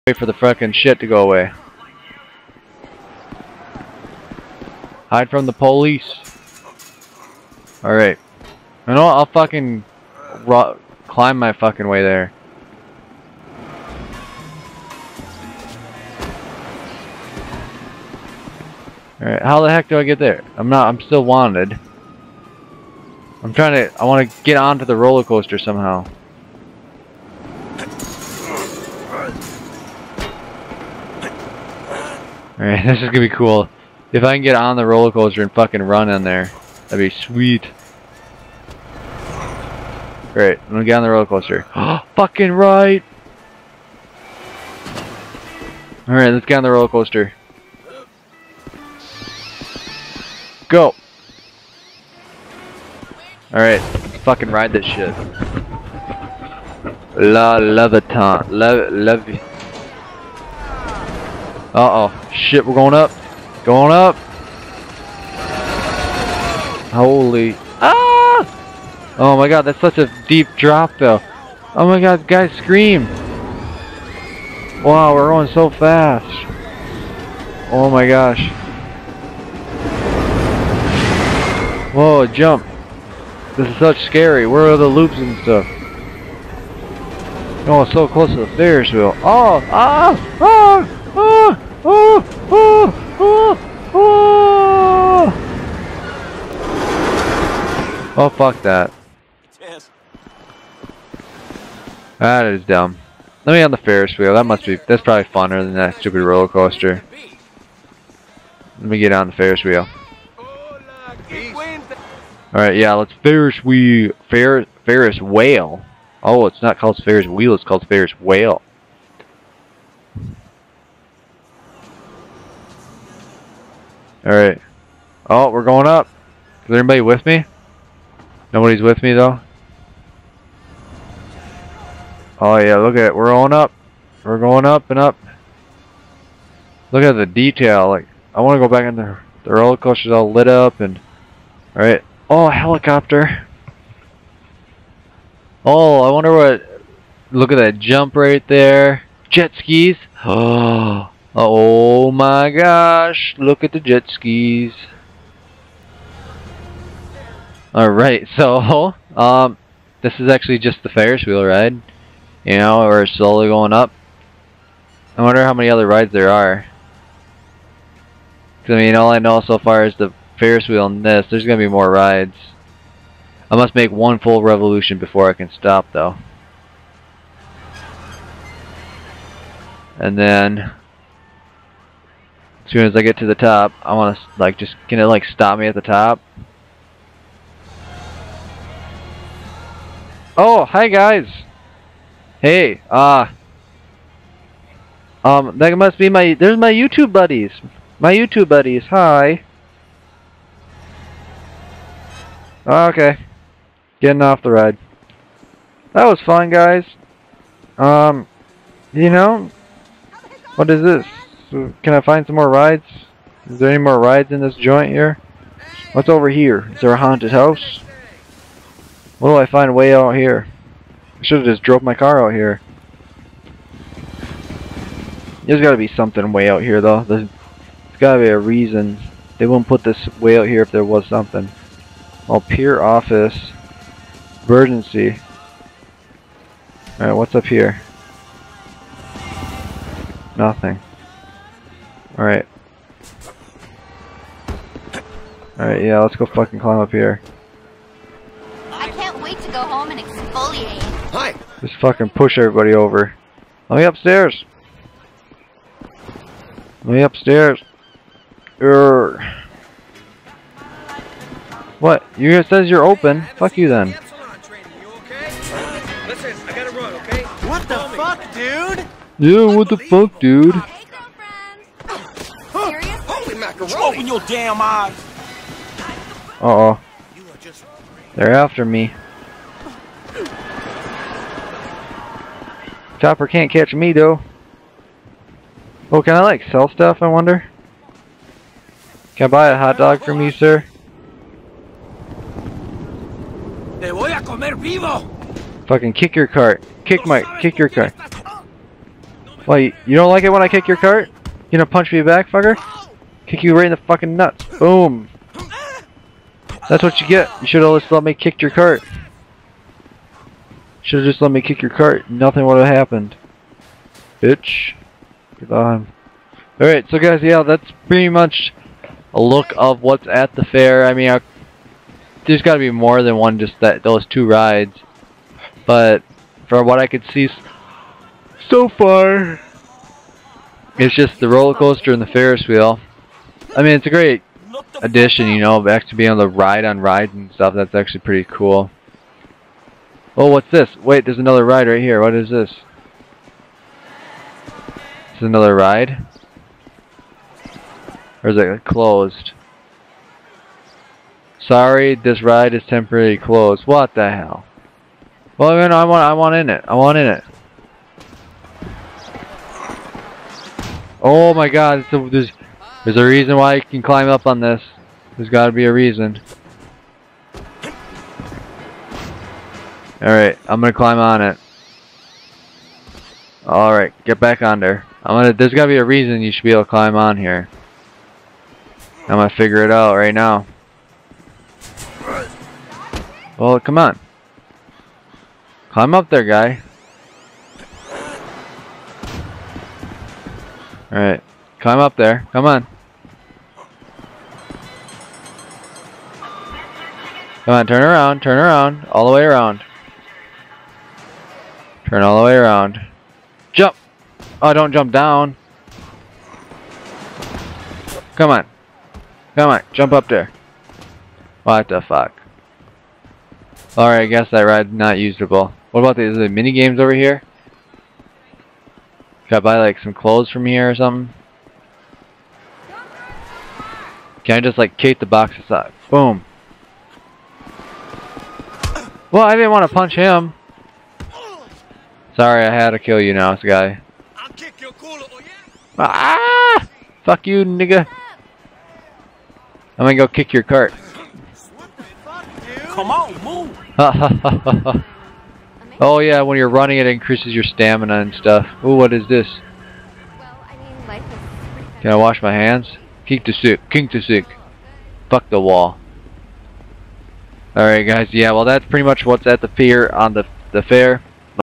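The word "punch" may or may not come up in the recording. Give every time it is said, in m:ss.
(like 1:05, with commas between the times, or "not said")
5:01, 7:09.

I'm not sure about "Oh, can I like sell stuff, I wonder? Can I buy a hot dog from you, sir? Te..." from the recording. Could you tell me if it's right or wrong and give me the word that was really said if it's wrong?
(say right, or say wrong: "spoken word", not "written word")
right.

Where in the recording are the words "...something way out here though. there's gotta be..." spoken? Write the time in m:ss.
3:45.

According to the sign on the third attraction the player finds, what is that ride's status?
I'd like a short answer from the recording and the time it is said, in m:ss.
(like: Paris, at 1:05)
Temporarily closed, at 5:52.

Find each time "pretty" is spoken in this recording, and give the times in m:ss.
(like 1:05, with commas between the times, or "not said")
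5:17, 5:37, 7:38.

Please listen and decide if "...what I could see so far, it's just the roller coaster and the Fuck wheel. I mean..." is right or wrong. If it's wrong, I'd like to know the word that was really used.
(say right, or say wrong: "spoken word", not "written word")
wrong: "Ferris", not "Fuck".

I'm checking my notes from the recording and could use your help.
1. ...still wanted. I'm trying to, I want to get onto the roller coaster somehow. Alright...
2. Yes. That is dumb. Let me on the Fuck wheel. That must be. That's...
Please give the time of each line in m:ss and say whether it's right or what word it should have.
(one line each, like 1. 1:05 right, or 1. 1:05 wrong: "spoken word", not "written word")
1. 0:20 right
2. 1:39 wrong: "Ferris", not "Fuck".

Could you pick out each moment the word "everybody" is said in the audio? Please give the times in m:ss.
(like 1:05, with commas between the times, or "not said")
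4:12.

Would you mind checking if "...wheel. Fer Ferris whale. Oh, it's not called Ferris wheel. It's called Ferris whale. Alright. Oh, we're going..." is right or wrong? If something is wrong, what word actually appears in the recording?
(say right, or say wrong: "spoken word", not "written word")
right.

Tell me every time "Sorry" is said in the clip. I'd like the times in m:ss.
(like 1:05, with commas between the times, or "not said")
5:51, 7:12.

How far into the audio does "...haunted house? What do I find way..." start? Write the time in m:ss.
3:36.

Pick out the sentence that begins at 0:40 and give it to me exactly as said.
Alright, I'm gonna get on the roller coaster.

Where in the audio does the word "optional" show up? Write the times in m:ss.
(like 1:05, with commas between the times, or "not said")
not said.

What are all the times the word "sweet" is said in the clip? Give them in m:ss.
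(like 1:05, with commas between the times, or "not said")
0:37.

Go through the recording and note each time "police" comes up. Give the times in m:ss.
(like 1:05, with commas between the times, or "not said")
0:05.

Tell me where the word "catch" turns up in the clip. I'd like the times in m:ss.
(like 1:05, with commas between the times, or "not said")
4:43.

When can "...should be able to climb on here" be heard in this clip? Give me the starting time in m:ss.
6:16.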